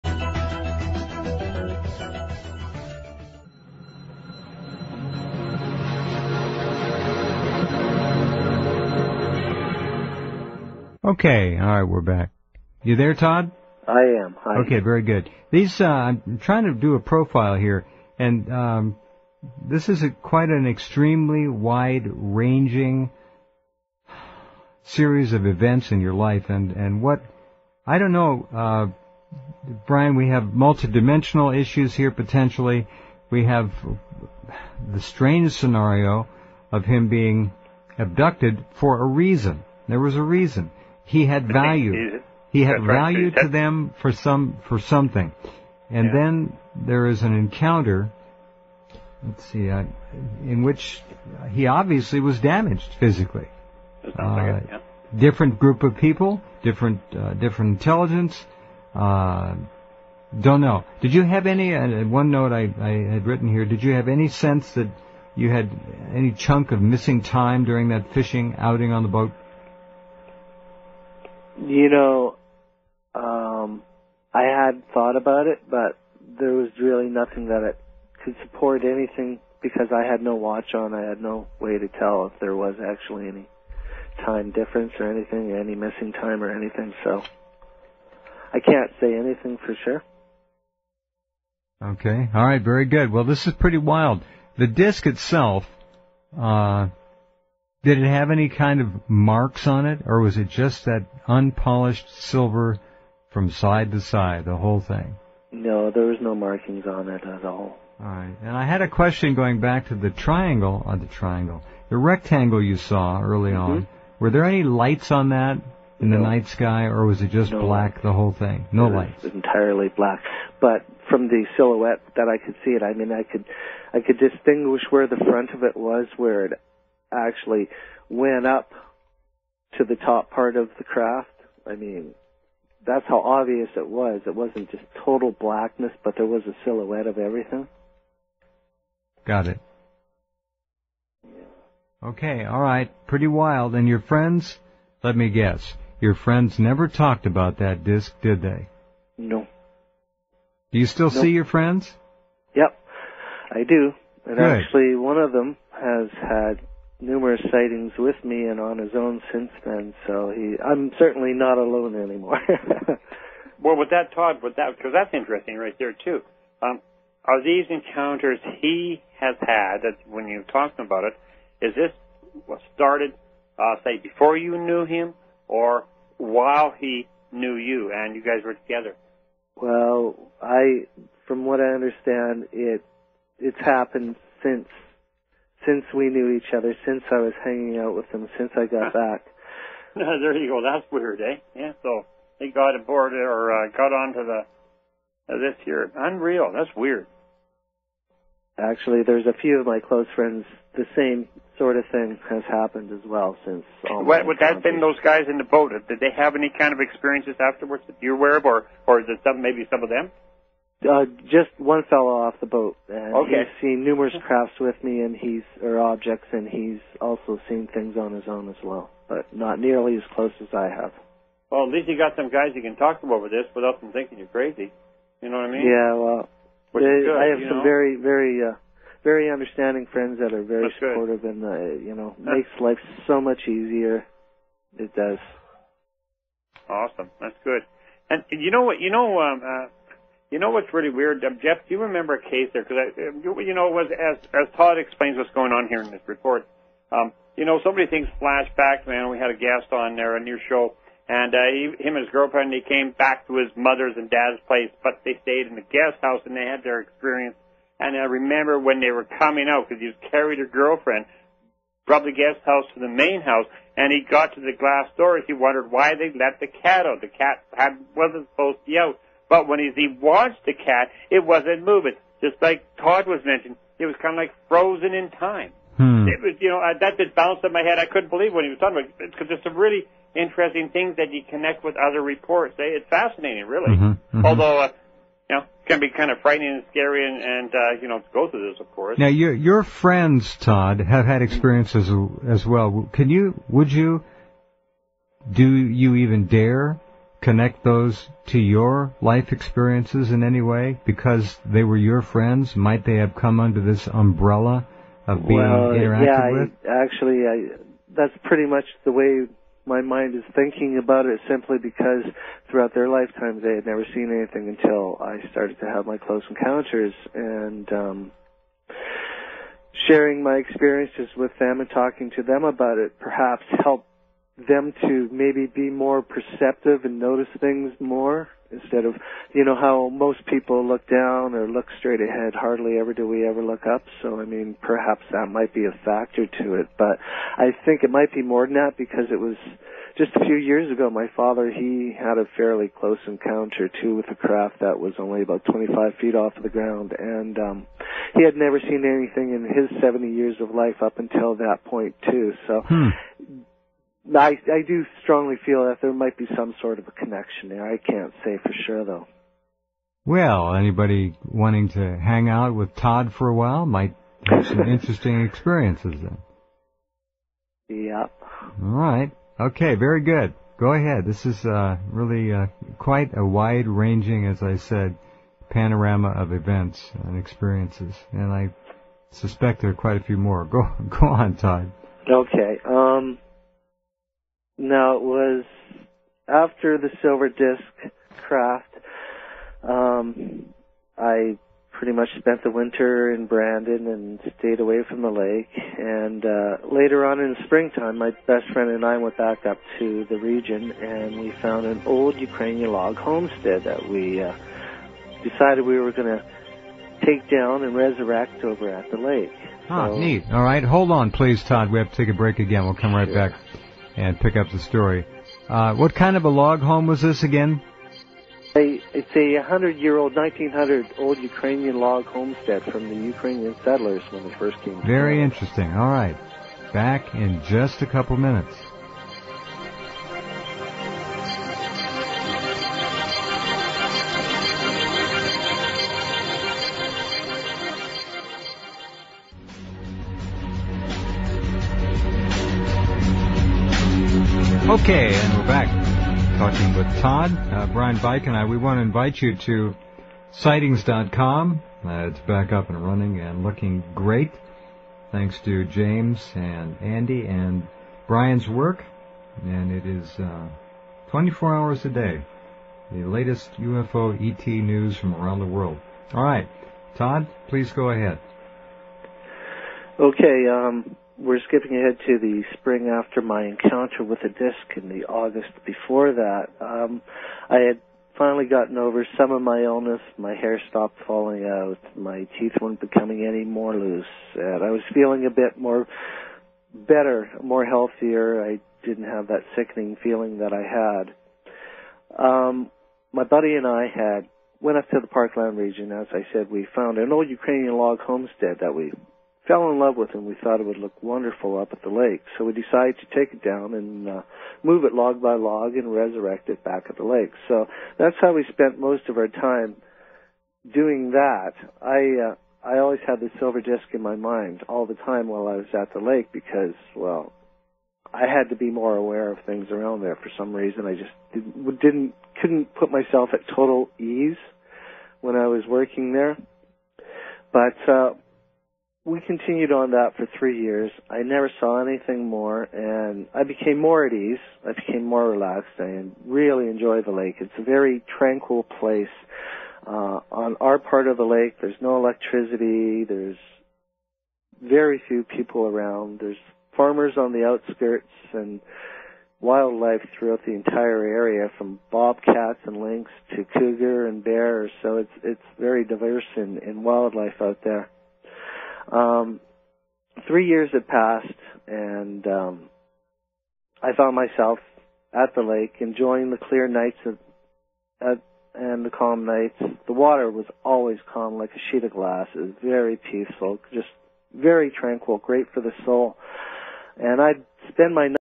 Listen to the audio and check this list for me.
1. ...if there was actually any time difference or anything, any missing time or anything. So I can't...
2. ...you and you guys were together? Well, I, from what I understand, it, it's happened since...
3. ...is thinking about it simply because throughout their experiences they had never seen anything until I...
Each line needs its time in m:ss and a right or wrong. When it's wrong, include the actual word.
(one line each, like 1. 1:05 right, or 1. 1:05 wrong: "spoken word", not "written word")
1. 1:22 right
2. 2:57 right
3. 5:10 wrong: "lifetimes", not "experiences".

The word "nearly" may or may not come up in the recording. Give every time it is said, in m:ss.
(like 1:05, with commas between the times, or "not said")
3:39.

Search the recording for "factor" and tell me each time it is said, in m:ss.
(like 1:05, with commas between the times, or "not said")
5:35.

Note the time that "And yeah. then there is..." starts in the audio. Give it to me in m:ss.
0:45.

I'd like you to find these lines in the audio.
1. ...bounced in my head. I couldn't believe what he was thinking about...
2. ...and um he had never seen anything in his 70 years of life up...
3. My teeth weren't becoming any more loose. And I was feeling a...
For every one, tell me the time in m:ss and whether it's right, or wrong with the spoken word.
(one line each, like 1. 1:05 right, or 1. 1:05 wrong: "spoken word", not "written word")
1. 4:37 wrong: "talking", not "thinking"
2. 5:46 right
3. 8:01 right.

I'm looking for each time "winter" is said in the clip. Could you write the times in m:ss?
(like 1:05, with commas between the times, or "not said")
6:32.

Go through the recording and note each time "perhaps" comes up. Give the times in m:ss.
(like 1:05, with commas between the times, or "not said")
5:22, 5:34.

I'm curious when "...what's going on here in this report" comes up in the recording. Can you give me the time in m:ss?
4:05.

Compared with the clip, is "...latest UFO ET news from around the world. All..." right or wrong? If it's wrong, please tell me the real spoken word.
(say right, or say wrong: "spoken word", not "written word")
right.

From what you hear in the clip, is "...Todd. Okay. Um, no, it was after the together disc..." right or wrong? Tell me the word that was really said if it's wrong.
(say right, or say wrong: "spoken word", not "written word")
wrong: "silver", not "together".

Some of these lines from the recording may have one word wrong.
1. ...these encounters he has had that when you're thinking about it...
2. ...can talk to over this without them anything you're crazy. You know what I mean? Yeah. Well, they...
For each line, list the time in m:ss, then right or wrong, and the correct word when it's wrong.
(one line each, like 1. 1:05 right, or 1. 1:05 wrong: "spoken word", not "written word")
1. 2:47 wrong: "talking", not "thinking"
2. 3:42 wrong: "thinking", not "anything".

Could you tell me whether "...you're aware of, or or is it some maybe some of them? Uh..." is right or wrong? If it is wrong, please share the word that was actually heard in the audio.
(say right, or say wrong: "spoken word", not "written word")
right.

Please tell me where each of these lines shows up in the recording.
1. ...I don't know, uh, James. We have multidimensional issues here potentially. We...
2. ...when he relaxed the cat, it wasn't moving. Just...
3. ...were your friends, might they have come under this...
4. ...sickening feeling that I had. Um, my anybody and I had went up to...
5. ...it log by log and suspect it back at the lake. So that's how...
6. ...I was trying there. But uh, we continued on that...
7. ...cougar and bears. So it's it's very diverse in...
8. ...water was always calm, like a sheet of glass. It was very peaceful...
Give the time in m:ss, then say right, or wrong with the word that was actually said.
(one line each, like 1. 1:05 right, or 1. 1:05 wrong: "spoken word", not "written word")
1. 0:27 wrong: "Brian", not "James"
2. 4:29 wrong: "watched", not "relaxed"
3. 5:01 right
4. 8:09 wrong: "buddy", not "anybody"
5. 8:24 wrong: "resurrect", not "suspect"
6. 8:45 wrong: "working", not "trying"
7. 9:13 right
8. 9:29 right.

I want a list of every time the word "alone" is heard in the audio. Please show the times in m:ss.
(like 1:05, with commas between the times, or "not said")
2:41.